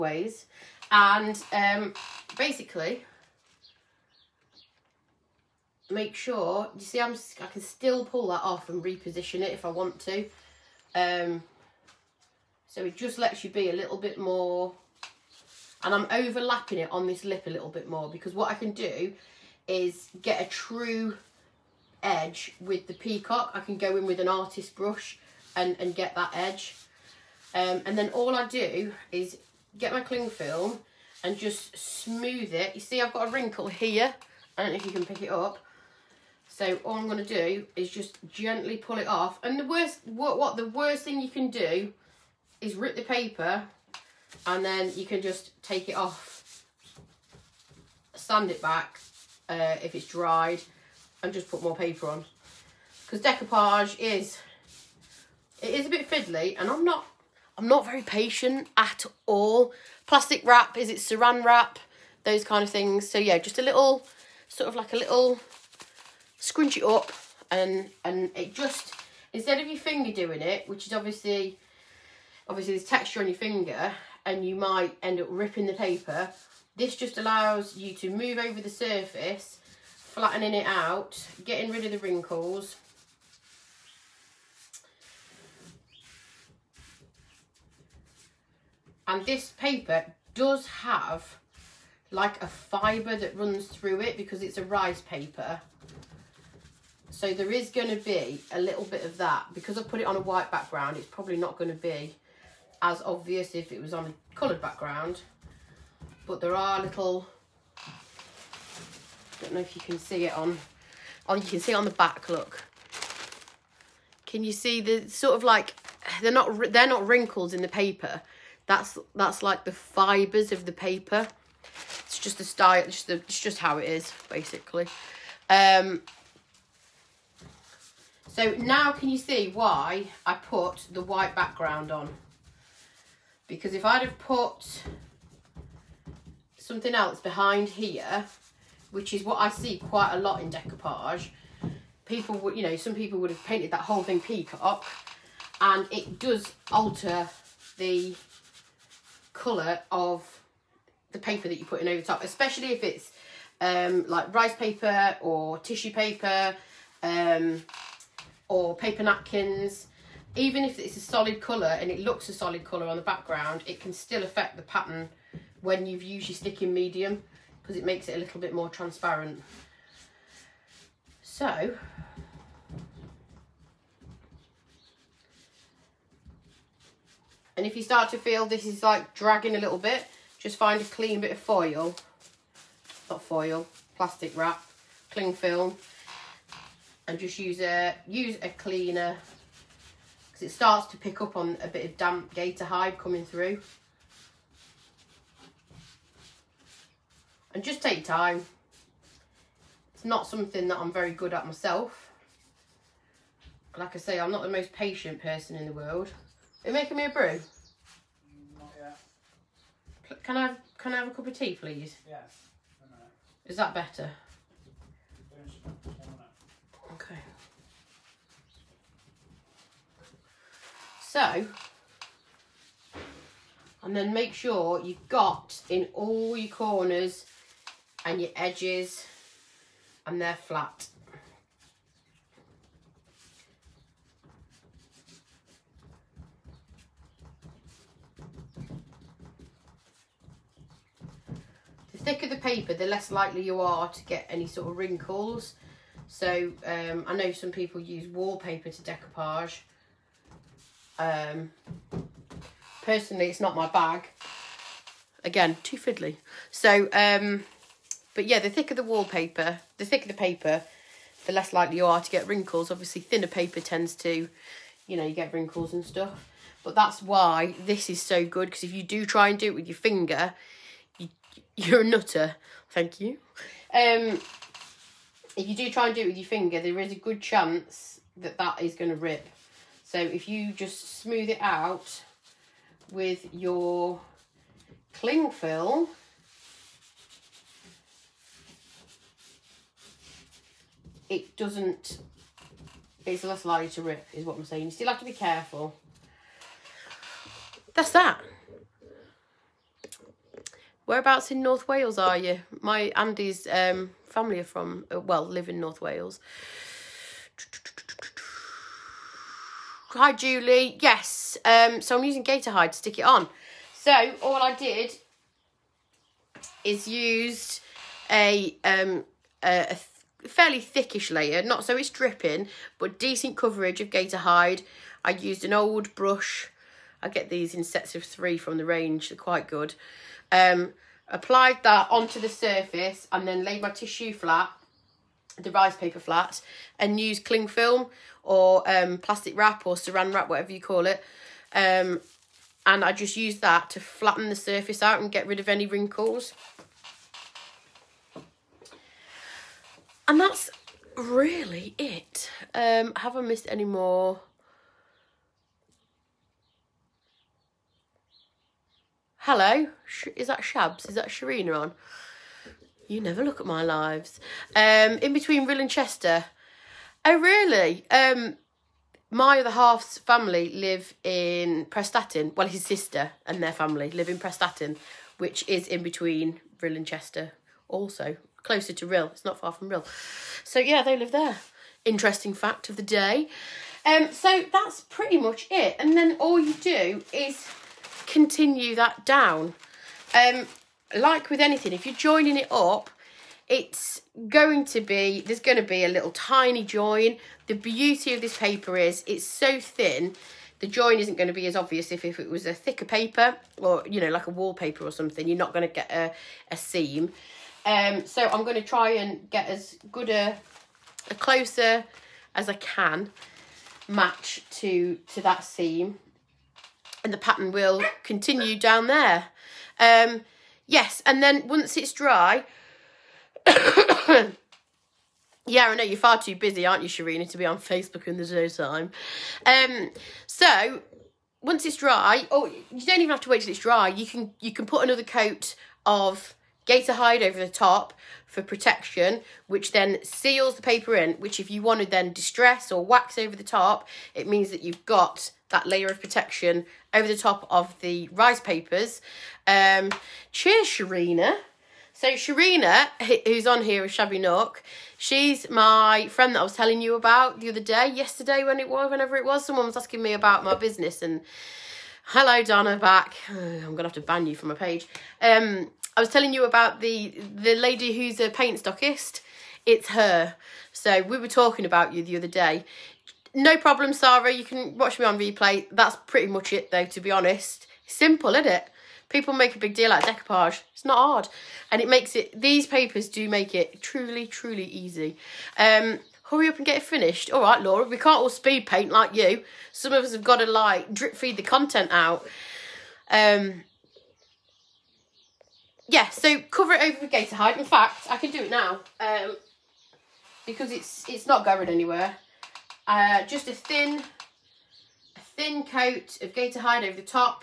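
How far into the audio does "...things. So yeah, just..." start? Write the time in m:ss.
1:02.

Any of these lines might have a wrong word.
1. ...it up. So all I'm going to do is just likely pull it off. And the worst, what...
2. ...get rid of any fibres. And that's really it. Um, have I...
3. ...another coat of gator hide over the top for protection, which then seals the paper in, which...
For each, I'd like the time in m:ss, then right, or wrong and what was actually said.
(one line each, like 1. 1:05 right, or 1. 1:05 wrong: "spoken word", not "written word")
1. 0:35 wrong: "gently", not "likely"
2. 5:45 wrong: "wrinkles", not "fibres"
3. 7:14 right.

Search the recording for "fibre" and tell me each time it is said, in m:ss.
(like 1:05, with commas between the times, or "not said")
1:32, 1:59.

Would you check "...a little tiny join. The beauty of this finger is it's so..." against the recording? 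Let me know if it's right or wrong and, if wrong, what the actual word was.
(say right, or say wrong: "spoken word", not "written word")
wrong: "paper", not "finger".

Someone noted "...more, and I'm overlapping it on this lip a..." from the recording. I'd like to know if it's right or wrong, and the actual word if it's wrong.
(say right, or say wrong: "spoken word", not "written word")
right.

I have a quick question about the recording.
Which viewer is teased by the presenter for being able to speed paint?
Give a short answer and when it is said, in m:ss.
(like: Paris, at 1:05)
Laura, at 8:07.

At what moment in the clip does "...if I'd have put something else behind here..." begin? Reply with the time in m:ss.
2:13.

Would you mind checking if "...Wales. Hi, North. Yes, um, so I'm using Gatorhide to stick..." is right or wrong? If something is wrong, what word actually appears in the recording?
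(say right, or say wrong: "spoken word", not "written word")
wrong: "Julie", not "North".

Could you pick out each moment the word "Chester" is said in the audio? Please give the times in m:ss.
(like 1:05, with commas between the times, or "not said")
6:05, 6:16.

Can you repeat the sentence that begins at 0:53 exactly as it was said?
Because decoupage is, it is a bit fiddly and I'm not, I'm not very patient at all.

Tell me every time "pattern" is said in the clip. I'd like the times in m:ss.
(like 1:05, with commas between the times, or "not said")
2:44, 6:57.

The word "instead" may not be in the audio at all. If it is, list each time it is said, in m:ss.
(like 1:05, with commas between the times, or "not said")
1:09.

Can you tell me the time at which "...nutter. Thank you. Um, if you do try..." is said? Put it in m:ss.
4:31.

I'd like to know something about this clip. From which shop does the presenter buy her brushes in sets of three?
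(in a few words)
The Range.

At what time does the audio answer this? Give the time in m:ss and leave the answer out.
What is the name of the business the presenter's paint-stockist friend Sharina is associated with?
7:33.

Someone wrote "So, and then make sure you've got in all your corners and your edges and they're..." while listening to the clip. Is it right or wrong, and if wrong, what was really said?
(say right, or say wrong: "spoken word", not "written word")
right.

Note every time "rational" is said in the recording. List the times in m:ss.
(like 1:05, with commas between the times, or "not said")
not said.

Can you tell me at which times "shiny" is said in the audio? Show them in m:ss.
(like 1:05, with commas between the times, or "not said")
not said.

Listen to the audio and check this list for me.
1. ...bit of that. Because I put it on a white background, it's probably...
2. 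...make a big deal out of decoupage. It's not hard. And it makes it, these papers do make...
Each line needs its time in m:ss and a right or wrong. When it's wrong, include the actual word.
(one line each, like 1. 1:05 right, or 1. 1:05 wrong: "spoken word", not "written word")
1. 1:38 right
2. 7:59 right.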